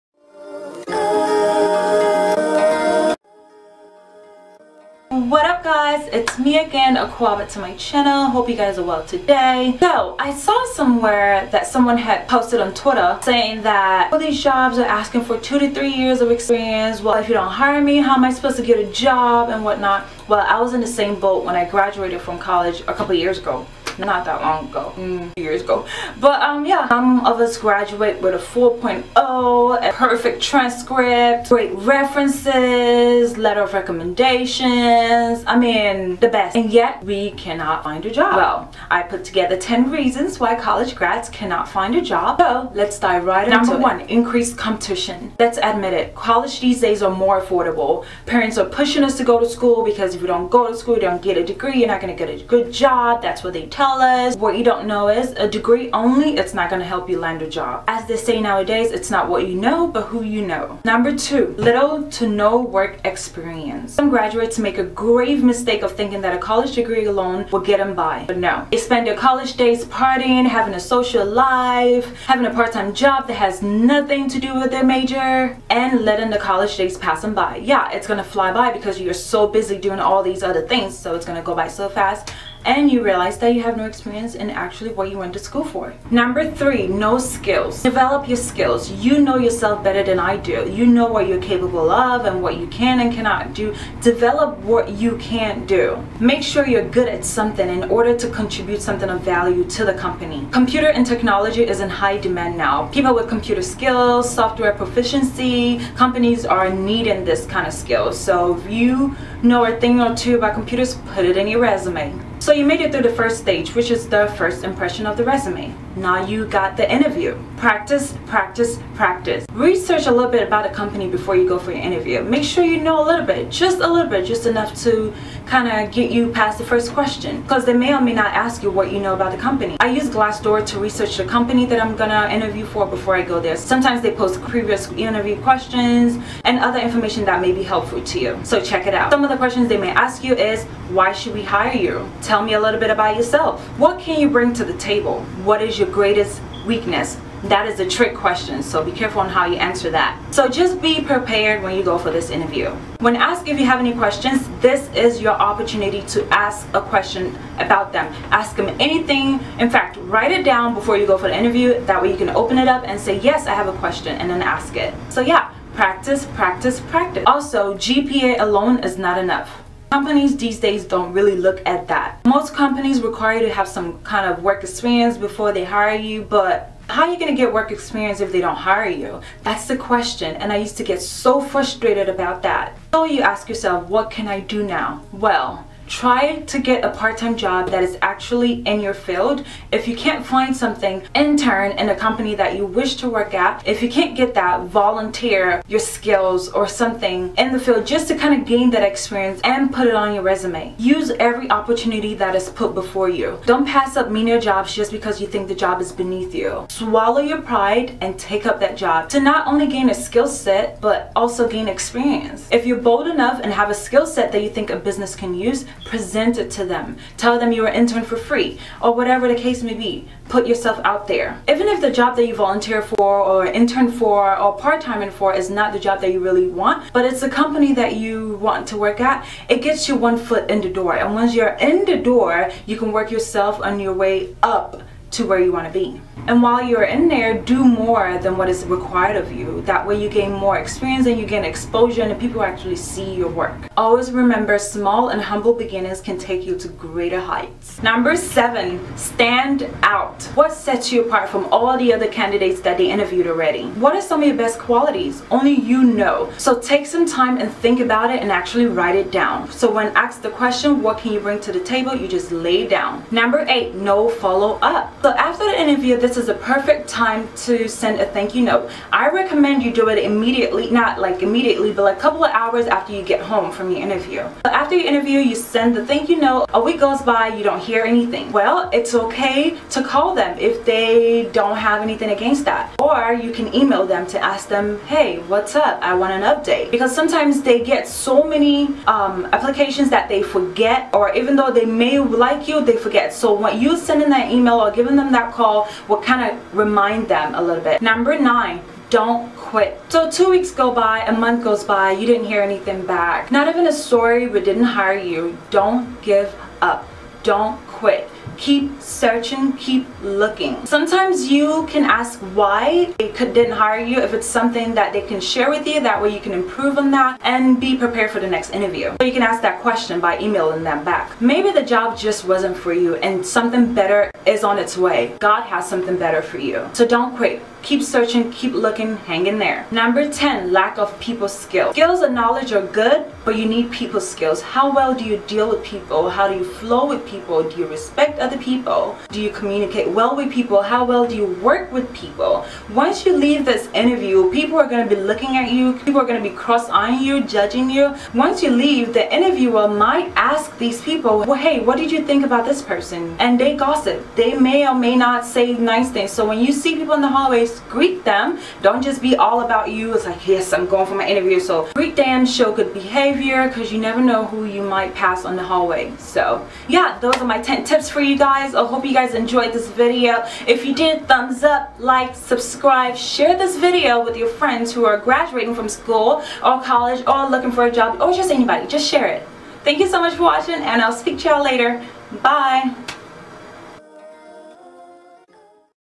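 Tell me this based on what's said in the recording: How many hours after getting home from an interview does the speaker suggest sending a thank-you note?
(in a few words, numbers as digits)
A couple of hours.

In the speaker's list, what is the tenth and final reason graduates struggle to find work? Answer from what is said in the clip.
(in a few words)
Lack of people skills.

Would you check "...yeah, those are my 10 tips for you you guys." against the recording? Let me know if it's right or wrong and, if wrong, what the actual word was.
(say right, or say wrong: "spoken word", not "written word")
right.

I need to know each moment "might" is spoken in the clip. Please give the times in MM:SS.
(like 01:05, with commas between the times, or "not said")
05:49, 06:04.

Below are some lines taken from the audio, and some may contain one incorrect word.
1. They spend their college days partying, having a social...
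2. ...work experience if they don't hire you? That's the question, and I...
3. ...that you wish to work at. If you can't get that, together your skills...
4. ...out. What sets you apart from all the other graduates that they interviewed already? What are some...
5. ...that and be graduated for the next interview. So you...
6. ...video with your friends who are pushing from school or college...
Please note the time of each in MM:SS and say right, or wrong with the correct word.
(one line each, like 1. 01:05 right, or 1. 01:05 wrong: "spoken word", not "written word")
1. 01:08 right
2. 02:57 right
3. 03:12 wrong: "volunteer", not "together"
4. 04:09 wrong: "candidates", not "graduates"
5. 05:16 wrong: "prepared", not "graduated"
6. 06:13 wrong: "graduating", not "pushing".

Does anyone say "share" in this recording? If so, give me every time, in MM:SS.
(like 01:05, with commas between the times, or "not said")
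05:15, 06:12, 06:18.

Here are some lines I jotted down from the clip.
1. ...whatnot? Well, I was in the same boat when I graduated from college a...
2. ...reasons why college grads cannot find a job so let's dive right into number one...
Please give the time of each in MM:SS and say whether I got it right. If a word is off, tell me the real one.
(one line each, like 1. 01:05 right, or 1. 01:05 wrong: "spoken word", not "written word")
1. 00:19 right
2. 00:39 right.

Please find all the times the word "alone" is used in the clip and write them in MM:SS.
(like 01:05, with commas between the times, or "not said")
01:07, 02:48.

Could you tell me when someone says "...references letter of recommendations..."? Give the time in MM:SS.
00:31.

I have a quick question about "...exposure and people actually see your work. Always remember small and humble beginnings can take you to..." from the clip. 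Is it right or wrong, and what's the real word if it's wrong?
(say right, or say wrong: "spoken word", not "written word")
right.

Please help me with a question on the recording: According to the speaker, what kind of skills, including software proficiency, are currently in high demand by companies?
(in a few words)
Computer skills.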